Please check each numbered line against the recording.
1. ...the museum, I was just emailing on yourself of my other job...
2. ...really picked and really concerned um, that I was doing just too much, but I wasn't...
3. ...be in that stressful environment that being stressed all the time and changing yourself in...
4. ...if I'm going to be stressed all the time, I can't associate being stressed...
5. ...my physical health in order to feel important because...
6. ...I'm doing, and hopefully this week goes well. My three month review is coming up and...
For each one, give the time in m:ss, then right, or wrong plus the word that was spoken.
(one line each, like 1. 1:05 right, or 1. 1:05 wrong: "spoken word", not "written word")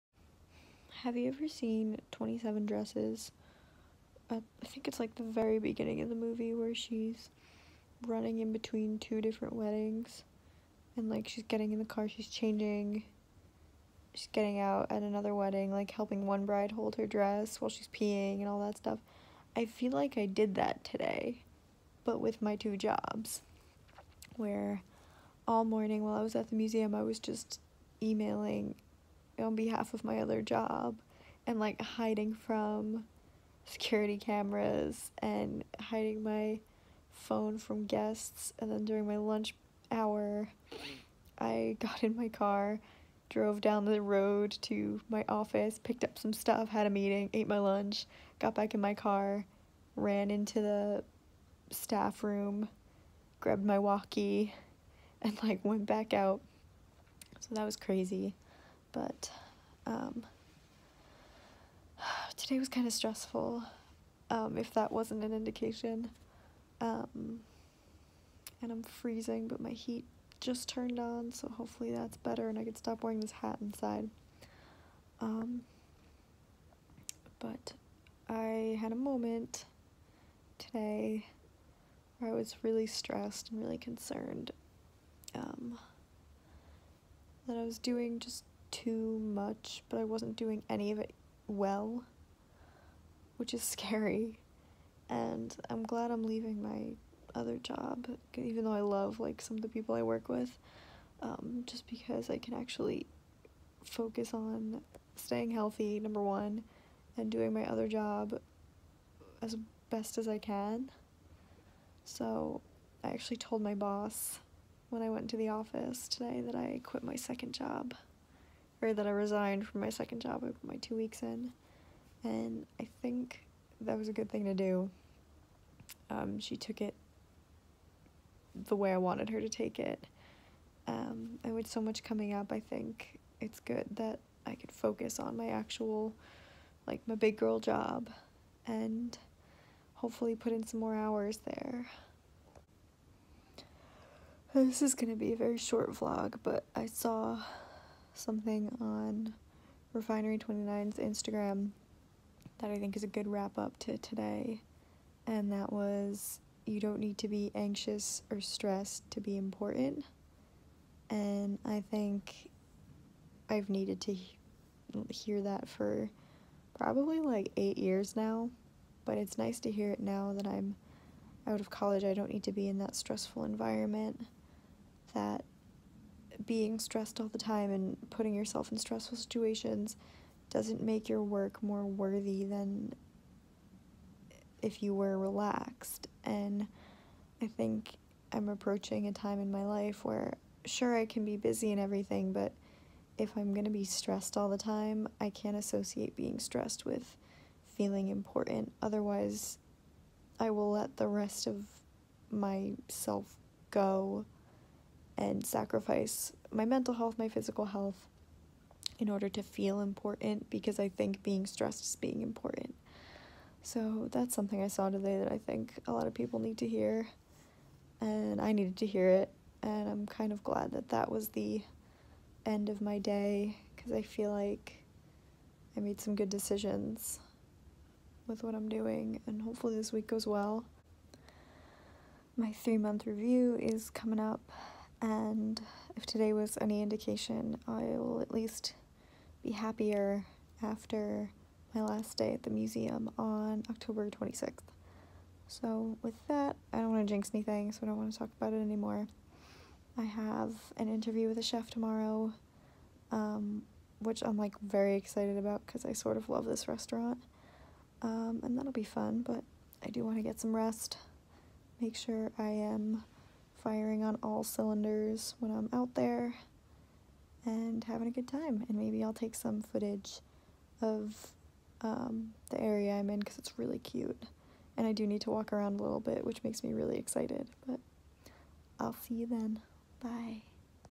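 1. 0:26 wrong: "behalf", not "yourself"
2. 1:22 wrong: "stressed", not "picked"
3. 2:52 wrong: "putting", not "changing"
4. 3:13 right
5. 3:27 right
6. 3:48 right.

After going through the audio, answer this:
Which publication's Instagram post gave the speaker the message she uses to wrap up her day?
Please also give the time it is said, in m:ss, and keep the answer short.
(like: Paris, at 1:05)
Refinery29, at 2:29.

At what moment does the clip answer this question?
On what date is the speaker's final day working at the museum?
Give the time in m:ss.
4:03.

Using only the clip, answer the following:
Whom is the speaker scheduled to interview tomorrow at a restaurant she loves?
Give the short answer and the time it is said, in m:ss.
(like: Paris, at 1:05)
a chef, at 4:11.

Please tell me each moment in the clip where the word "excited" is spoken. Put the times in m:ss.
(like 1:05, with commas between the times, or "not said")
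4:14, 4:36.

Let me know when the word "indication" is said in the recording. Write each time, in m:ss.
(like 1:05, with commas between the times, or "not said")
1:05, 3:56.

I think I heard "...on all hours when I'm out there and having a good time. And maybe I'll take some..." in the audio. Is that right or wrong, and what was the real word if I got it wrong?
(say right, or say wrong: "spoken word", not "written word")
wrong: "cylinders", not "hours".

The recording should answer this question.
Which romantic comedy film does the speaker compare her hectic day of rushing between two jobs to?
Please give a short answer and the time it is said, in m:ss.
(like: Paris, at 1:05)
27 Dresses, at 0:02.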